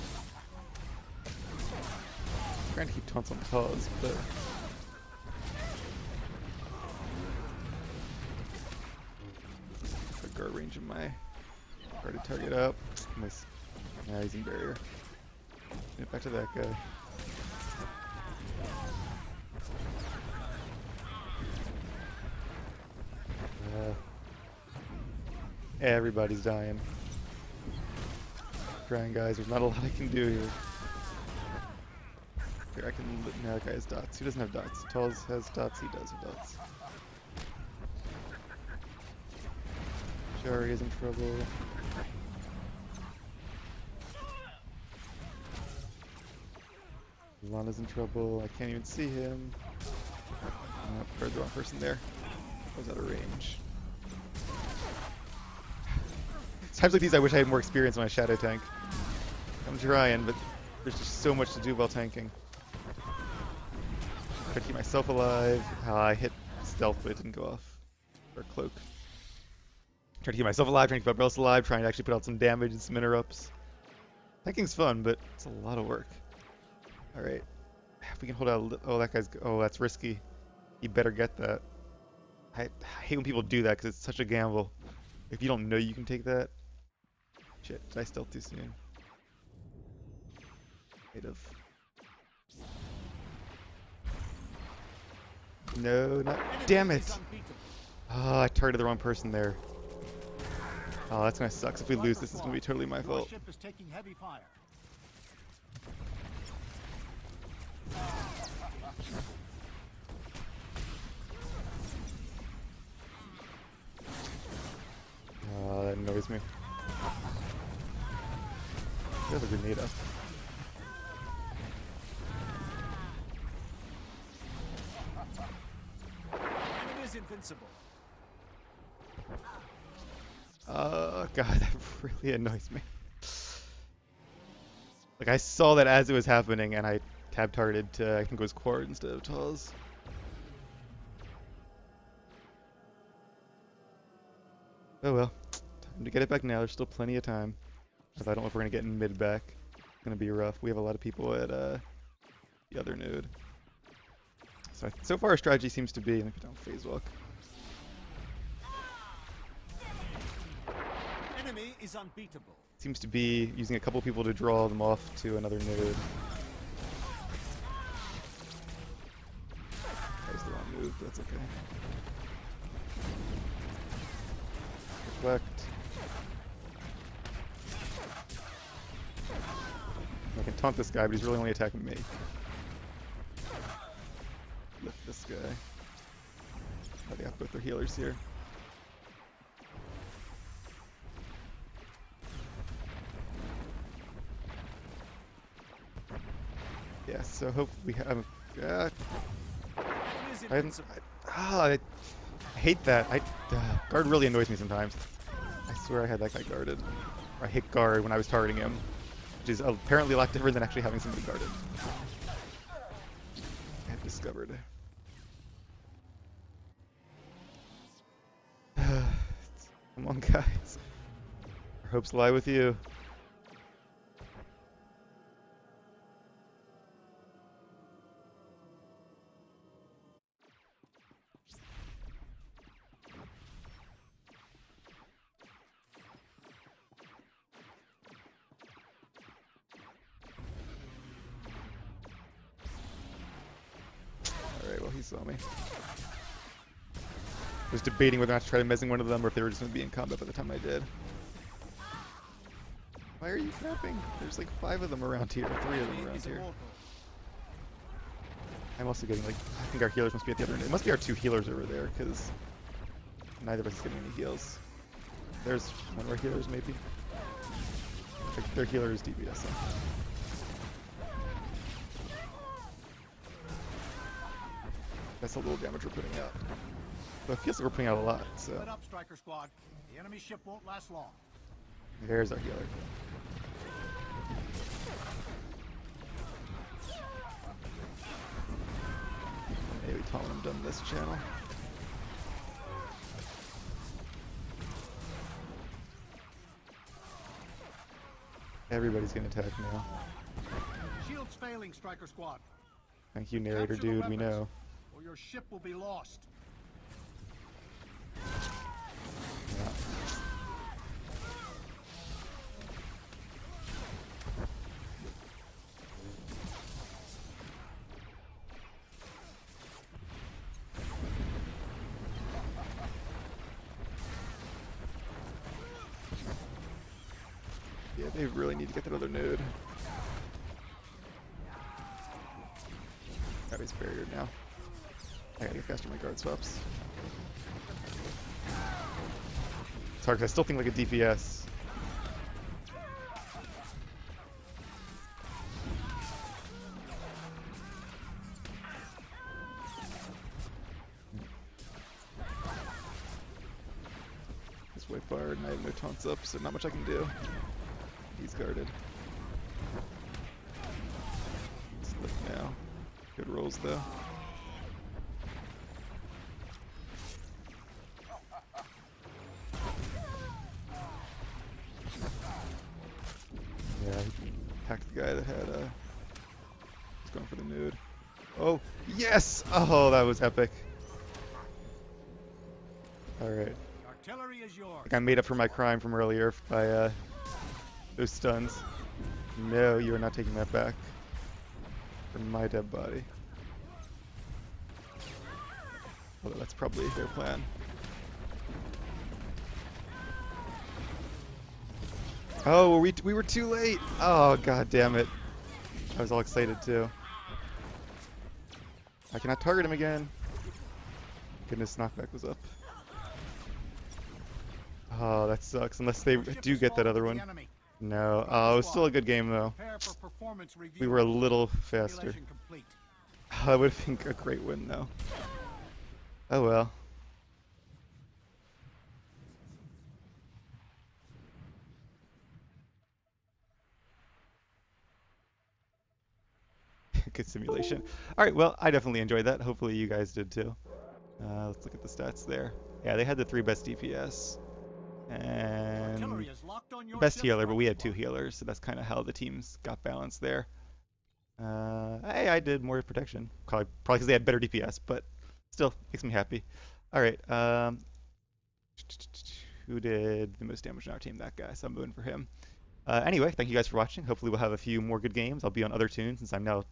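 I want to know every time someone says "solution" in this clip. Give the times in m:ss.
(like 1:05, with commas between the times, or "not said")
not said.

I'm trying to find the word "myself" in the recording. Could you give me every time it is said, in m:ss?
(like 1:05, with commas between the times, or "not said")
1:04, 1:10.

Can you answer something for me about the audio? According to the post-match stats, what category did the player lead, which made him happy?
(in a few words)
Protection.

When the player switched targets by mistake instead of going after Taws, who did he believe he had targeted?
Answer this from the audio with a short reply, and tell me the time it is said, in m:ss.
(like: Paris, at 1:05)
Quart, at 2:18.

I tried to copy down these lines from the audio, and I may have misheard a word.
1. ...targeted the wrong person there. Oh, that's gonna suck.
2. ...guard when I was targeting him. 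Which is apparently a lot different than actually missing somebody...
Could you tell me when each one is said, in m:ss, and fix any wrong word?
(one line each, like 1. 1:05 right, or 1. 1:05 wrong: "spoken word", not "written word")
1. 1:38 right
2. 3:27 wrong: "having", not "missing".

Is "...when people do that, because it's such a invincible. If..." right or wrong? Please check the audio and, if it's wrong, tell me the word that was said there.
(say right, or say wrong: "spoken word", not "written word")
wrong: "gamble", not "invincible".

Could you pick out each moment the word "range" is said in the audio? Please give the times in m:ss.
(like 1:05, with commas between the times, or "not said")
0:10, 0:53.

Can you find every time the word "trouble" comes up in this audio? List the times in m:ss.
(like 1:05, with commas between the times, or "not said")
0:41, 0:47.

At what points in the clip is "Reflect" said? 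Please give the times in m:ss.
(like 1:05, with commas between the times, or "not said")
2:55.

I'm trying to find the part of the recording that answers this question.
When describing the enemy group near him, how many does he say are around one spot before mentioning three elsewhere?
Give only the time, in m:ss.
4:14.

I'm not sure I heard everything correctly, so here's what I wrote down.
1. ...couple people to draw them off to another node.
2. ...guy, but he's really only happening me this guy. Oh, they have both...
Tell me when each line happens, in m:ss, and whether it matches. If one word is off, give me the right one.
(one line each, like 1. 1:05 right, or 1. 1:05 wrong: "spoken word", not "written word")
1. 2:43 right
2. 3:00 wrong: "attacking", not "happening".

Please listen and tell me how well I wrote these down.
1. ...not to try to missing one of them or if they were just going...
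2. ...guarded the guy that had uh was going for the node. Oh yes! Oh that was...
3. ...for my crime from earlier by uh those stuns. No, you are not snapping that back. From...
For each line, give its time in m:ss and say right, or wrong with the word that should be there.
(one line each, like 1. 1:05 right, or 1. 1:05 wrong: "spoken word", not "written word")
1. 4:08 right
2. 6:14 wrong: "hacked", not "guarded"
3. 6:25 wrong: "taking", not "snapping".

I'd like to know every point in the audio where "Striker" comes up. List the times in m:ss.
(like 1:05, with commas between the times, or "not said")
4:38, 5:01.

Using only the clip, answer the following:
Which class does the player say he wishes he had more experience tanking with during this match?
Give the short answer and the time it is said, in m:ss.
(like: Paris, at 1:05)
Shadow, at 0:58.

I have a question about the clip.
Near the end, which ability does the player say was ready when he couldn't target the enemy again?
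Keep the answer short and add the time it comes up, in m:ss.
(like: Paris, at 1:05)
Knockback, at 6:51.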